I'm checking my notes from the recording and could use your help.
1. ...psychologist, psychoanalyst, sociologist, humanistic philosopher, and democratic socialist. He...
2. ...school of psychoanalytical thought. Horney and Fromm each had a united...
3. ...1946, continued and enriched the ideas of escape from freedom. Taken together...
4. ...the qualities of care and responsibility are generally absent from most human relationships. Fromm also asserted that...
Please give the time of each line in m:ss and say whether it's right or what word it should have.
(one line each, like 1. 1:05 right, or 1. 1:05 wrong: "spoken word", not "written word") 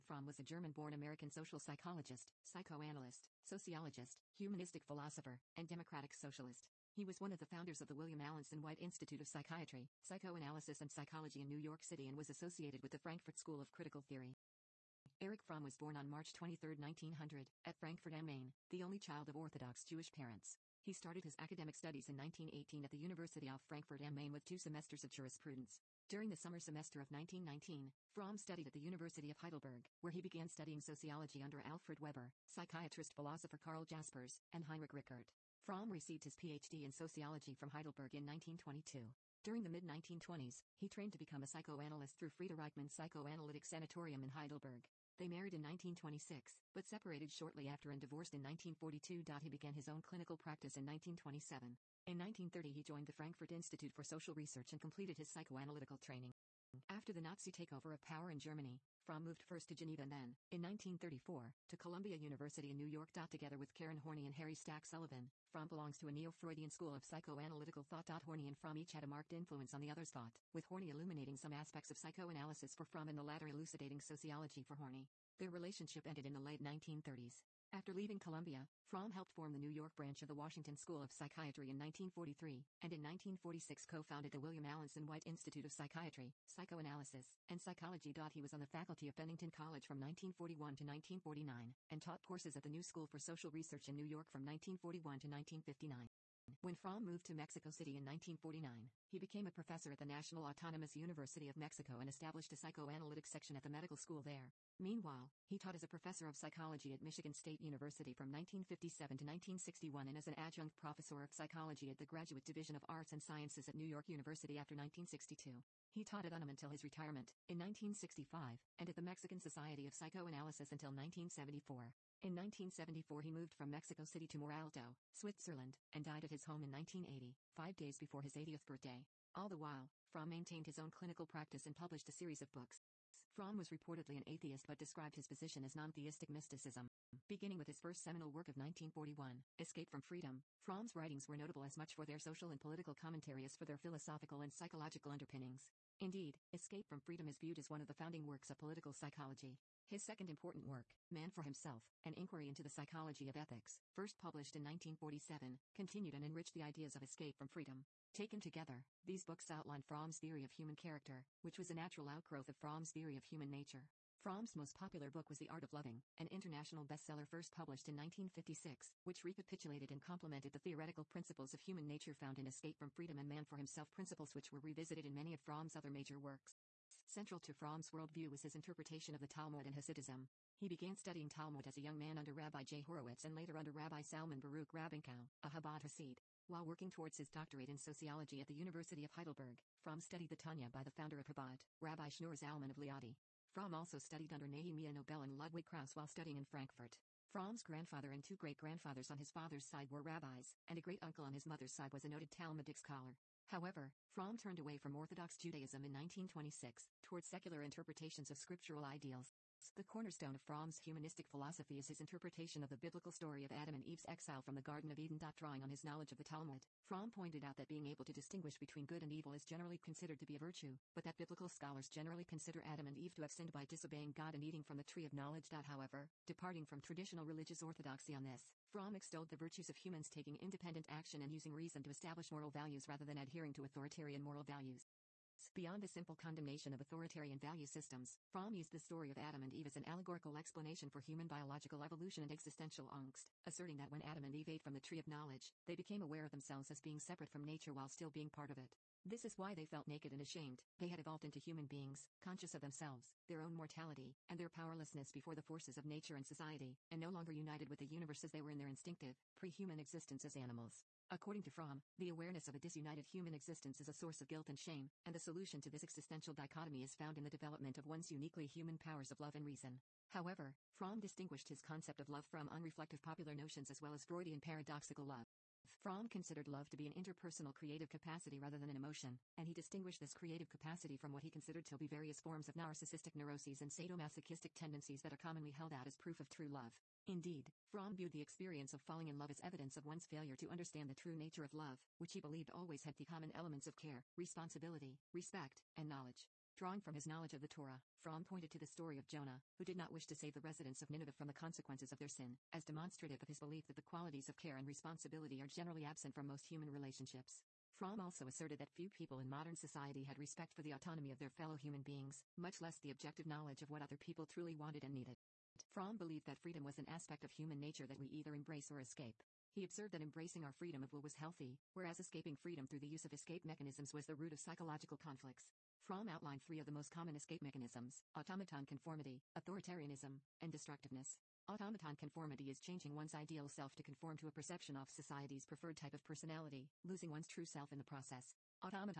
1. 0:01 right
2. 1:06 wrong: "marked", not "united"
3. 2:34 wrong: "1947", not "1946"
4. 5:03 right.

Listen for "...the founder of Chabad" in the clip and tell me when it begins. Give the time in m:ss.
3:10.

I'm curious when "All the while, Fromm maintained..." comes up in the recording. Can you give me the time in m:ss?
2:09.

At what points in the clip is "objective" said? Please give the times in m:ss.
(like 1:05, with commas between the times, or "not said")
5:12.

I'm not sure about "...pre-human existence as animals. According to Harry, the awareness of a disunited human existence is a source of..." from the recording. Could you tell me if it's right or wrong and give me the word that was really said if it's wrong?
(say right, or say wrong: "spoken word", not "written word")
wrong: "Fromm", not "Harry".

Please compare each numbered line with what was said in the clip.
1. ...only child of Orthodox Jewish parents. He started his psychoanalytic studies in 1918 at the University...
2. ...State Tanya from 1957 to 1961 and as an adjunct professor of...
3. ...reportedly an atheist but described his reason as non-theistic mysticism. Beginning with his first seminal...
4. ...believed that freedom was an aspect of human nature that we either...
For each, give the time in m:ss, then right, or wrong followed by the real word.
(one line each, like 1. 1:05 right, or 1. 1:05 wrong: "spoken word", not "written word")
1. 0:18 wrong: "academic", not "psychoanalytic"
2. 1:47 wrong: "University", not "Tanya"
3. 2:13 wrong: "position", not "reason"
4. 5:15 right.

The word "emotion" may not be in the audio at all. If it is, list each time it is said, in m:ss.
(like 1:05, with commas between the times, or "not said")
4:38.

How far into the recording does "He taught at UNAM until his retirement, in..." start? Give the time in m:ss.
1:55.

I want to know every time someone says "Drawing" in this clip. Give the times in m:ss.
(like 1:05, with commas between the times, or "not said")
3:35, 4:56.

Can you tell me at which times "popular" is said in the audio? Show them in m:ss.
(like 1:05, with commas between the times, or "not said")
2:44, 4:33.